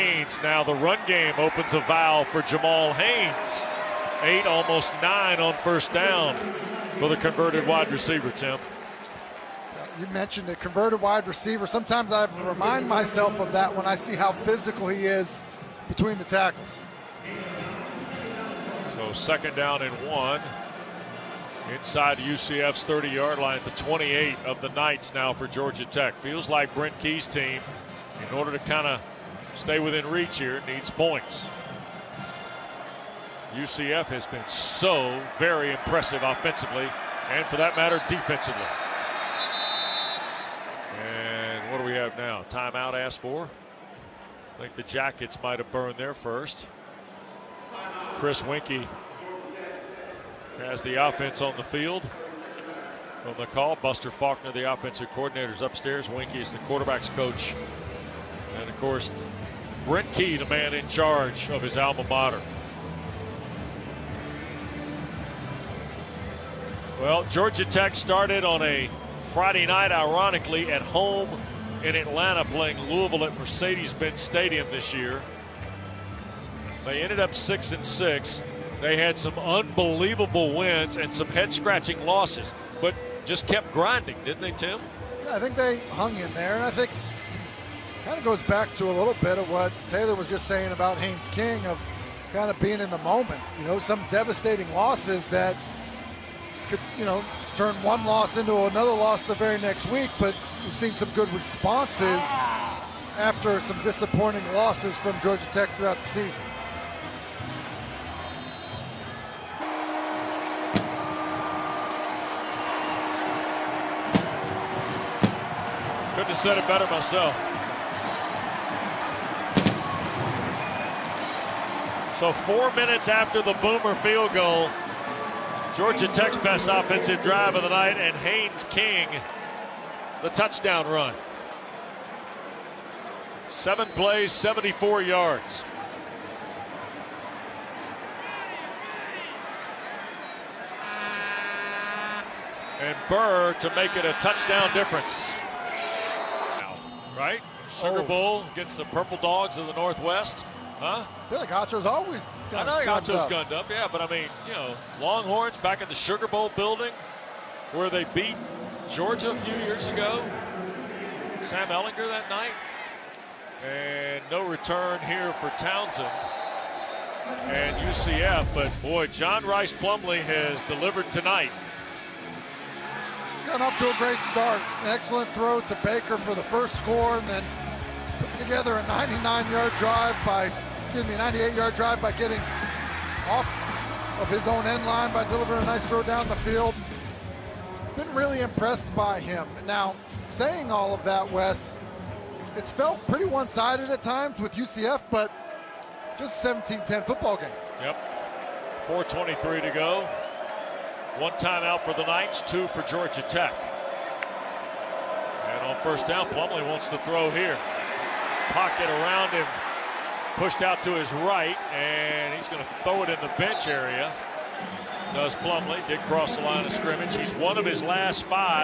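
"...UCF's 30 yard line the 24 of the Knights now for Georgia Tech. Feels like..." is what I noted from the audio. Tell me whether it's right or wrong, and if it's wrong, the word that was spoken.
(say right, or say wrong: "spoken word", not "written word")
wrong: "28", not "24".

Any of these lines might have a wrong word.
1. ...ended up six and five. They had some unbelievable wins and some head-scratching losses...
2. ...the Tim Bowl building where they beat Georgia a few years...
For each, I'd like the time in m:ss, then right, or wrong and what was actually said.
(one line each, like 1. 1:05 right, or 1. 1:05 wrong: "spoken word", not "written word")
1. 1:17 wrong: "six", not "five"
2. 2:35 wrong: "Sugar", not "Tim".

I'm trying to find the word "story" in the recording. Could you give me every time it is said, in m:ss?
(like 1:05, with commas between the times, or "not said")
not said.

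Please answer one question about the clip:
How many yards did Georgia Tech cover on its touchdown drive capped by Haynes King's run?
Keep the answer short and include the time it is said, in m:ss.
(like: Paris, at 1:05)
74, at 2:14.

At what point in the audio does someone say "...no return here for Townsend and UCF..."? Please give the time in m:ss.
2:44.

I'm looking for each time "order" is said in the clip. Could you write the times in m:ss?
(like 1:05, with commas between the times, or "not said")
0:28.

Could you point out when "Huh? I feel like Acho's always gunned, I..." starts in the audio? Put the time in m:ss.
2:30.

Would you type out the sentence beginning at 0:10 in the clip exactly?
You mentioned a converted wide receiver.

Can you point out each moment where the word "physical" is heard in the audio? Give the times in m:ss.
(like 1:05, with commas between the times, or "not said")
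0:14.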